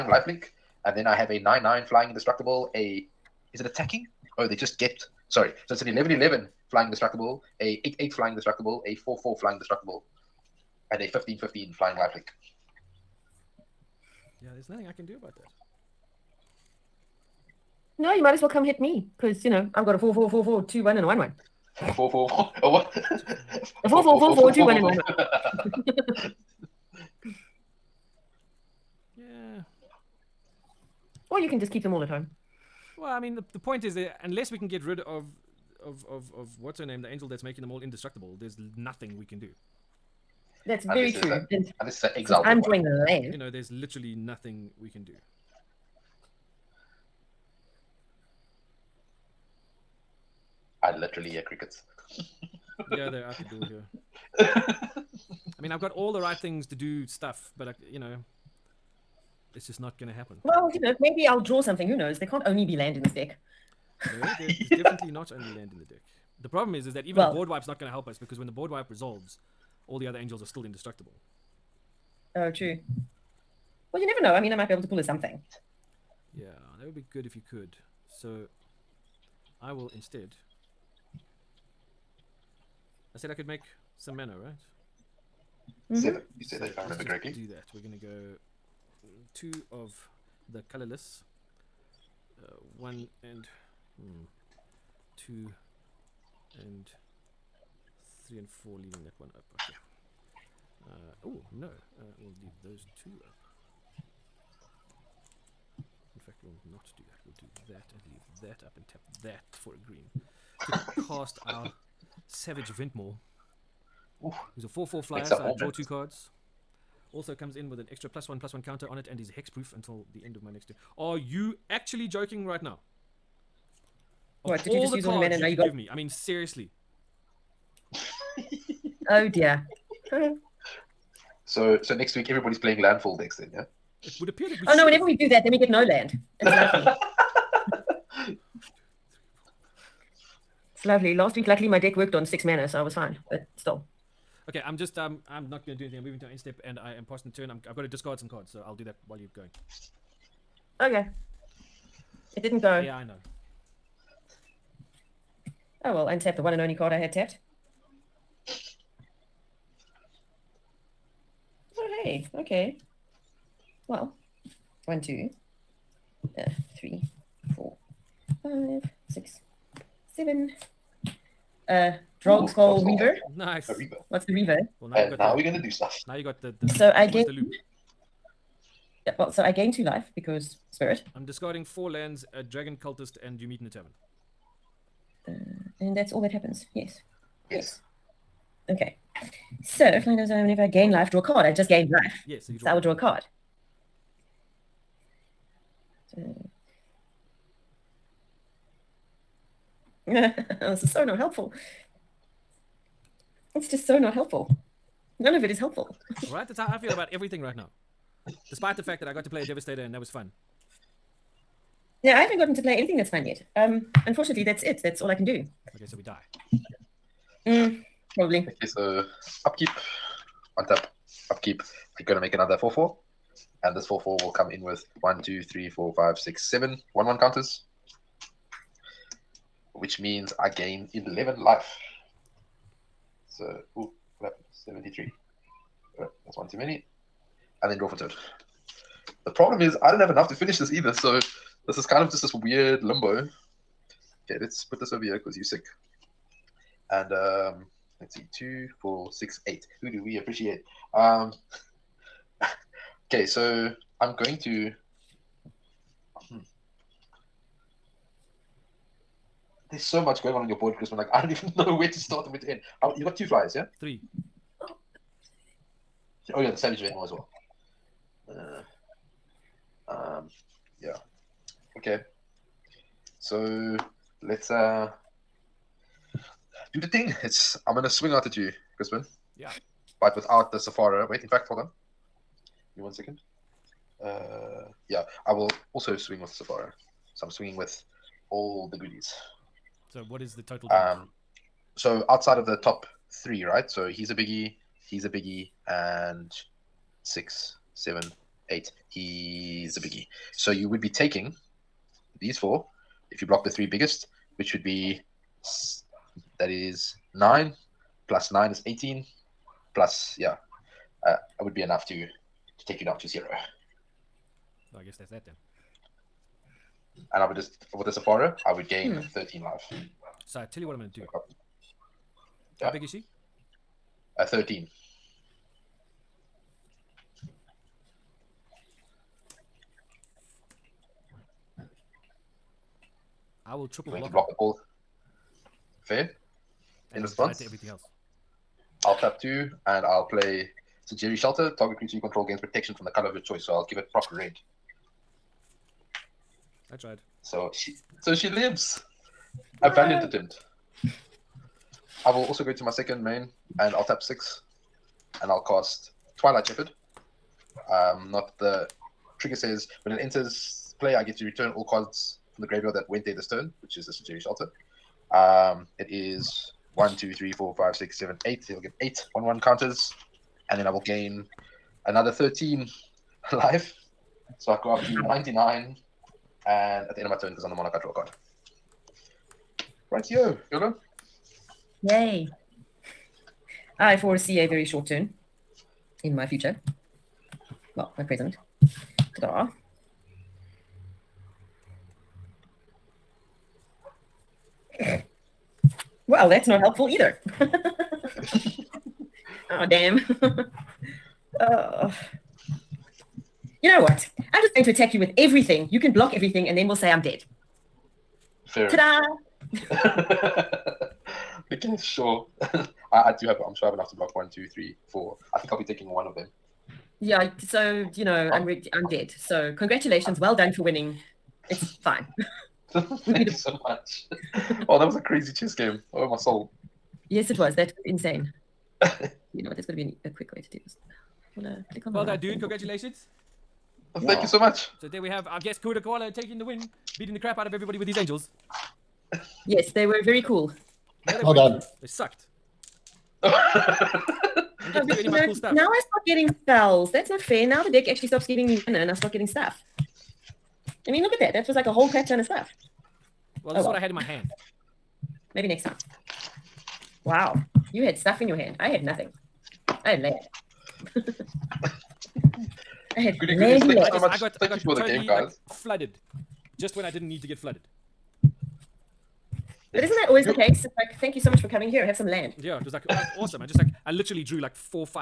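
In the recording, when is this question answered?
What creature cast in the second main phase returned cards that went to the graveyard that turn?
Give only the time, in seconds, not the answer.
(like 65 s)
356 s.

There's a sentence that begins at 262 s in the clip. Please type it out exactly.
Uh, you got two flyers, yeah?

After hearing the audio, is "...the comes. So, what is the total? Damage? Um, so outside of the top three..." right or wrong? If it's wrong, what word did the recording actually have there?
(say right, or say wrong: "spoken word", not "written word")
wrong: "goodies", not "comes".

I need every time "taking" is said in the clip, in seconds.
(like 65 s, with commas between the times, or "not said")
300 s, 415 s, 436 s.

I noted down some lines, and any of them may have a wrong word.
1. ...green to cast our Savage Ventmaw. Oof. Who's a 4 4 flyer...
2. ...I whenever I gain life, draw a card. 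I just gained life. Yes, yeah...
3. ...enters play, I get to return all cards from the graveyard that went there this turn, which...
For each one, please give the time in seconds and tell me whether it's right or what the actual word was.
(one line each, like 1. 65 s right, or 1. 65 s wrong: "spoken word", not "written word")
1. 109 s right
2. 190 s right
3. 359 s right.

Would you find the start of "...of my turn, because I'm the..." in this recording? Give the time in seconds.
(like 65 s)
377 s.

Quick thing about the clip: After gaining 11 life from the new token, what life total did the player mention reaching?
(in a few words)
73.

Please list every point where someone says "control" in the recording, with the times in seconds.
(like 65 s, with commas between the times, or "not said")
341 s.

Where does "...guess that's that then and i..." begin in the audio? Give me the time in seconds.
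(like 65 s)
314 s.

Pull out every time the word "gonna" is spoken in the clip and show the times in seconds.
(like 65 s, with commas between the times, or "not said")
87 s, 145 s, 222 s, 277 s.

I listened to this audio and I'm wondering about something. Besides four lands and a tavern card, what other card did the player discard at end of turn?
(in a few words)
dragon cultist.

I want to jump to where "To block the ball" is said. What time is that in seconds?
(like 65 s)
334 s.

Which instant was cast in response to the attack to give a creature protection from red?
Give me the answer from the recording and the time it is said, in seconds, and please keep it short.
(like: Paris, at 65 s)
Sejiri Shelter, at 340 s.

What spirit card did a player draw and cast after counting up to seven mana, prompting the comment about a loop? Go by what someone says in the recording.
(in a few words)
Drogskol Reaver.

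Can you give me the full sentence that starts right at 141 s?
Last week, luckily, my deck worked on six mana, so I was fine.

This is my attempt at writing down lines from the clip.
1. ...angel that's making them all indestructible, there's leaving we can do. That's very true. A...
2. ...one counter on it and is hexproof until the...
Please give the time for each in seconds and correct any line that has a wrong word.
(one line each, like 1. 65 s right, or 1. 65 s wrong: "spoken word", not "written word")
1. 37 s wrong: "nothing", not "leaving"
2. 118 s right.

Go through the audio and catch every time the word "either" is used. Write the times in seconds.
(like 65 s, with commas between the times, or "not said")
240 s, 396 s.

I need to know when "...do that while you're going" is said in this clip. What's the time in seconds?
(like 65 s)
148 s.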